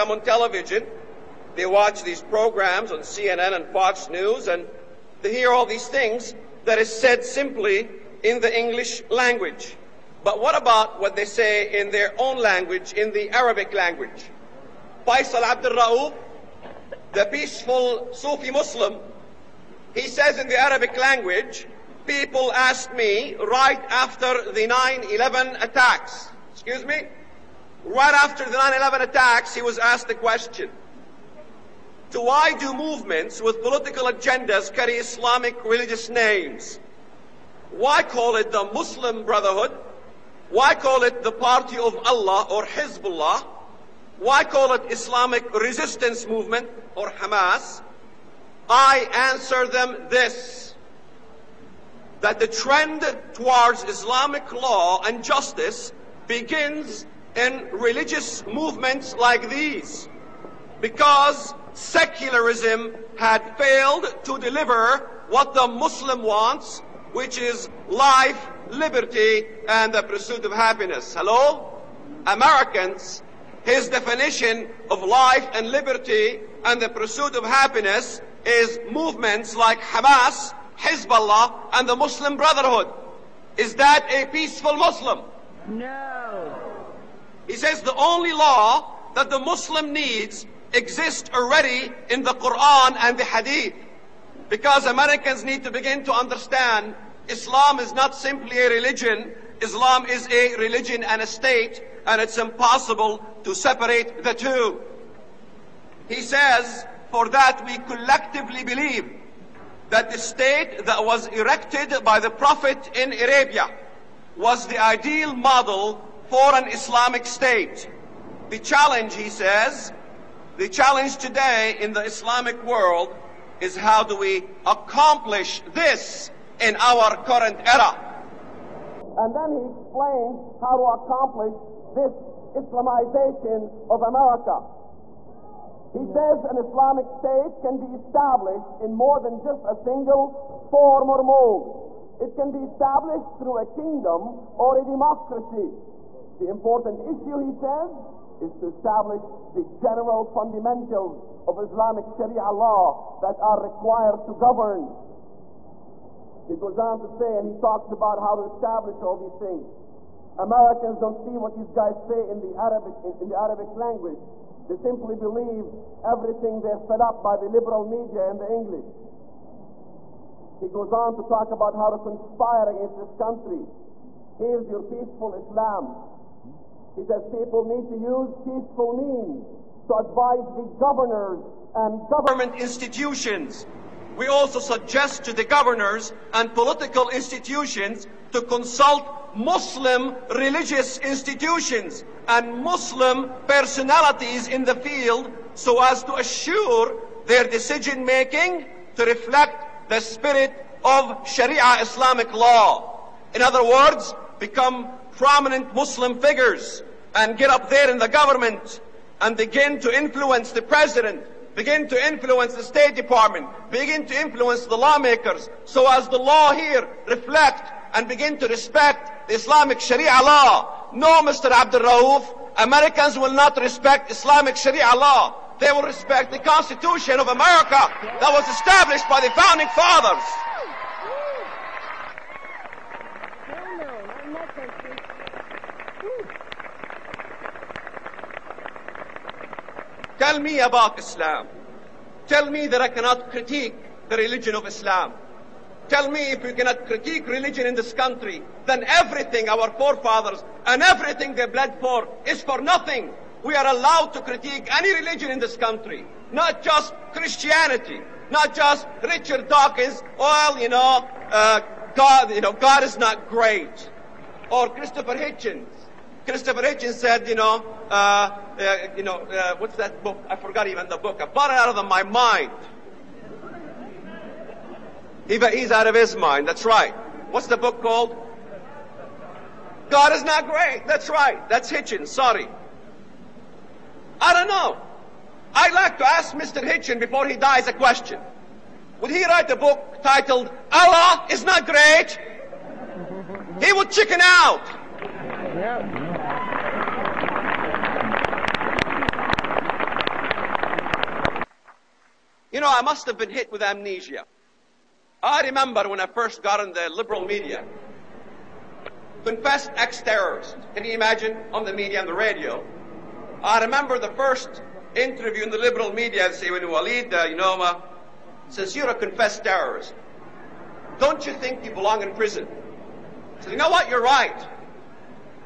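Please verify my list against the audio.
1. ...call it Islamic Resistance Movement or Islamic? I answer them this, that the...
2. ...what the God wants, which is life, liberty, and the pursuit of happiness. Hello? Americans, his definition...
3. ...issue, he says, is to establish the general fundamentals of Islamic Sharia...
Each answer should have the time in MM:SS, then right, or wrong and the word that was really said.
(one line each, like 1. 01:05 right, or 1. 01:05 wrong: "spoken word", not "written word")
1. 00:44 wrong: "Hamas", not "Islamic"
2. 01:05 wrong: "Muslim", not "God"
3. 02:26 right.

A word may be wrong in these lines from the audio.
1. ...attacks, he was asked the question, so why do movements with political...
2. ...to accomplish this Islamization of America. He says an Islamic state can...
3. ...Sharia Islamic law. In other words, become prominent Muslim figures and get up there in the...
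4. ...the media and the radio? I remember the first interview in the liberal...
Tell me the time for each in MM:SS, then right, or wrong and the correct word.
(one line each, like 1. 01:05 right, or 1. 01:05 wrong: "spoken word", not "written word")
1. 00:29 right
2. 02:10 right
3. 03:21 right
4. 05:11 right.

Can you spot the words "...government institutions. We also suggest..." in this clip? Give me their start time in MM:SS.
03:02.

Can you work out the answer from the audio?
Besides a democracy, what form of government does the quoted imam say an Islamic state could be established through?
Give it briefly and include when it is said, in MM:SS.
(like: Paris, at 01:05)
a kingdom, at 02:23.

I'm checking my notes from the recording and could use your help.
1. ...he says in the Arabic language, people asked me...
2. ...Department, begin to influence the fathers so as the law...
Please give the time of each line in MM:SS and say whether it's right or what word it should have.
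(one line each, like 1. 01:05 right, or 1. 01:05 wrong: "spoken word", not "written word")
1. 00:19 right
2. 03:32 wrong: "lawmakers", not "fathers".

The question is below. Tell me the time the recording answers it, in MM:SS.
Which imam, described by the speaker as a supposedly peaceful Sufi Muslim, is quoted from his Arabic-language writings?
00:15.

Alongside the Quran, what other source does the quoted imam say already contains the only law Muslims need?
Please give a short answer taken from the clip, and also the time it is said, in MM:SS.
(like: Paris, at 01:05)
Hadith, at 01:33.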